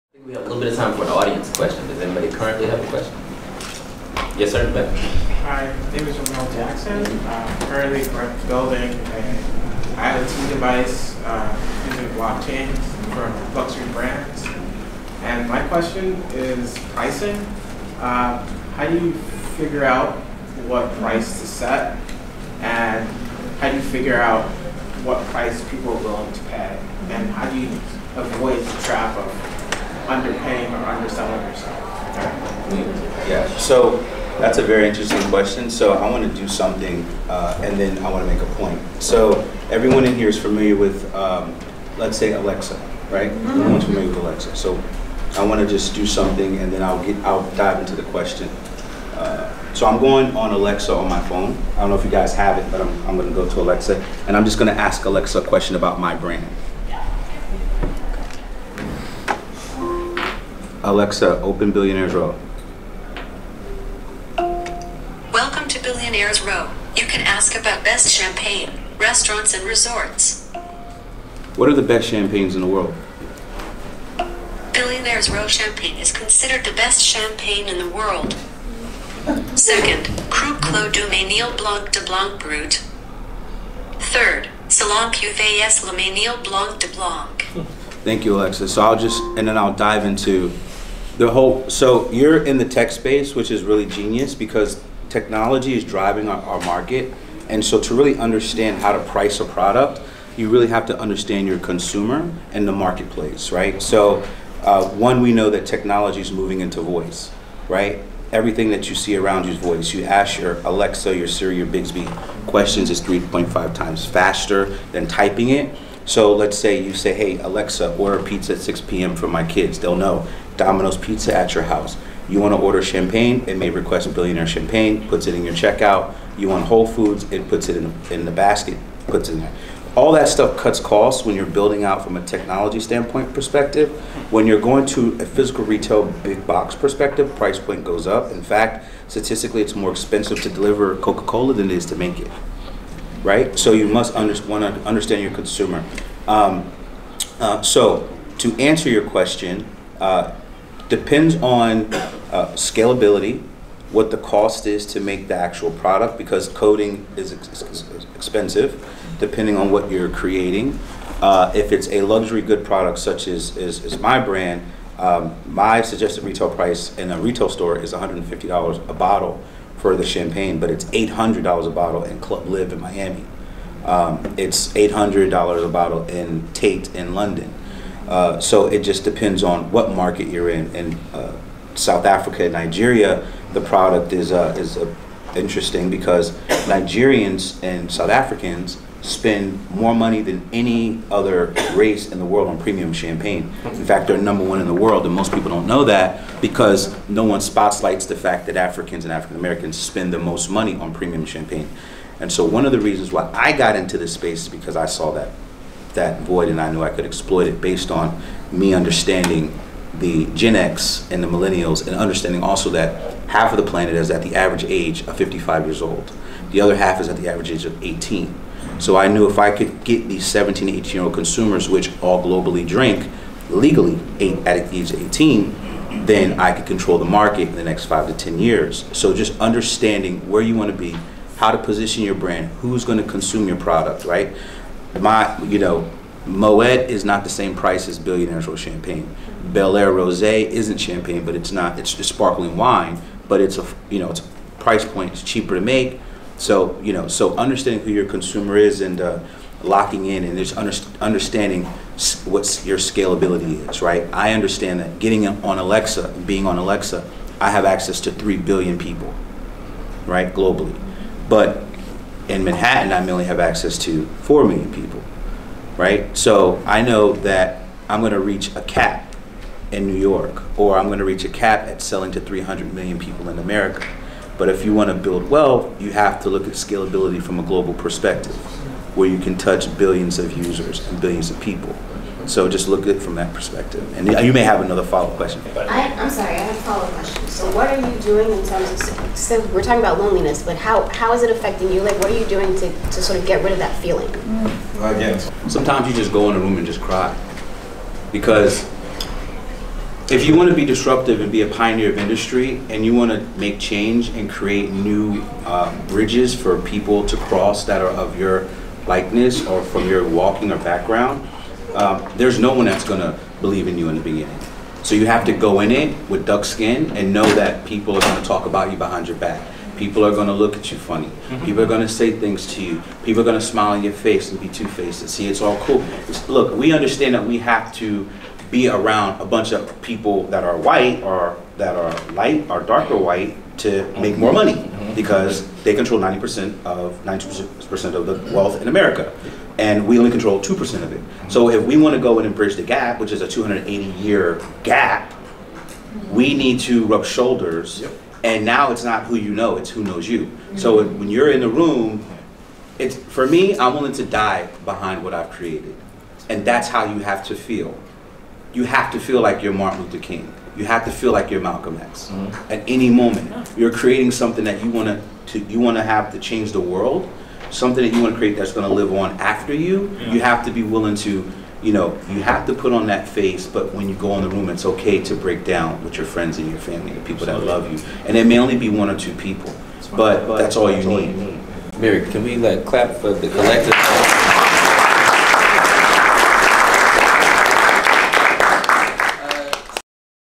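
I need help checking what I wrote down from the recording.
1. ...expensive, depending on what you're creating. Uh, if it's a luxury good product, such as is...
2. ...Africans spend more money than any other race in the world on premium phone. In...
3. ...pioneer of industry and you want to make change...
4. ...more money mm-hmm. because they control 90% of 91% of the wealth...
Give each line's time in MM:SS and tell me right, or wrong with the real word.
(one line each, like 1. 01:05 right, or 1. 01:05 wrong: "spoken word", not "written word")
1. 02:38 right
2. 03:08 wrong: "champagne", not "phone"
3. 05:01 right
4. 05:34 wrong: "90", not "91".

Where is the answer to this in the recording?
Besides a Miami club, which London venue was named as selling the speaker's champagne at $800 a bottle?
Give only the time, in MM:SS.
02:56.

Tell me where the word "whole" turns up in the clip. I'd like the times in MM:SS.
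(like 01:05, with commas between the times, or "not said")
01:31, 02:06.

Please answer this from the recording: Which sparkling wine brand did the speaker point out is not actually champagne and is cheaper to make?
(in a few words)
Belaire Rosé.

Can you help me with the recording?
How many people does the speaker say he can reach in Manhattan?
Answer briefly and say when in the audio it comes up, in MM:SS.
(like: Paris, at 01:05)
4 million, at 04:24.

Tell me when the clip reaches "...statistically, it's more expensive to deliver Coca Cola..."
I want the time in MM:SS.
02:19.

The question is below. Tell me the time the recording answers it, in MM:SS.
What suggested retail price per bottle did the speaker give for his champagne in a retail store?
02:47.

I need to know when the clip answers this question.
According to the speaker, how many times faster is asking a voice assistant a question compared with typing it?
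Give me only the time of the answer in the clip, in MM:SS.
01:52.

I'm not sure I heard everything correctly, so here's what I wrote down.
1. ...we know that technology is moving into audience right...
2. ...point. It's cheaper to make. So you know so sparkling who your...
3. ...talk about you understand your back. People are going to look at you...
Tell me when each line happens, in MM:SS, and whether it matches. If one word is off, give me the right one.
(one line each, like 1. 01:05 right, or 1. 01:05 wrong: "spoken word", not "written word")
1. 01:45 wrong: "voice", not "audience"
2. 04:04 wrong: "understanding", not "sparkling"
3. 05:18 wrong: "behind", not "understand".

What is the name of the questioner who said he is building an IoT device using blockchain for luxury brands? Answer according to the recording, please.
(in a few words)
Ramel Jackson.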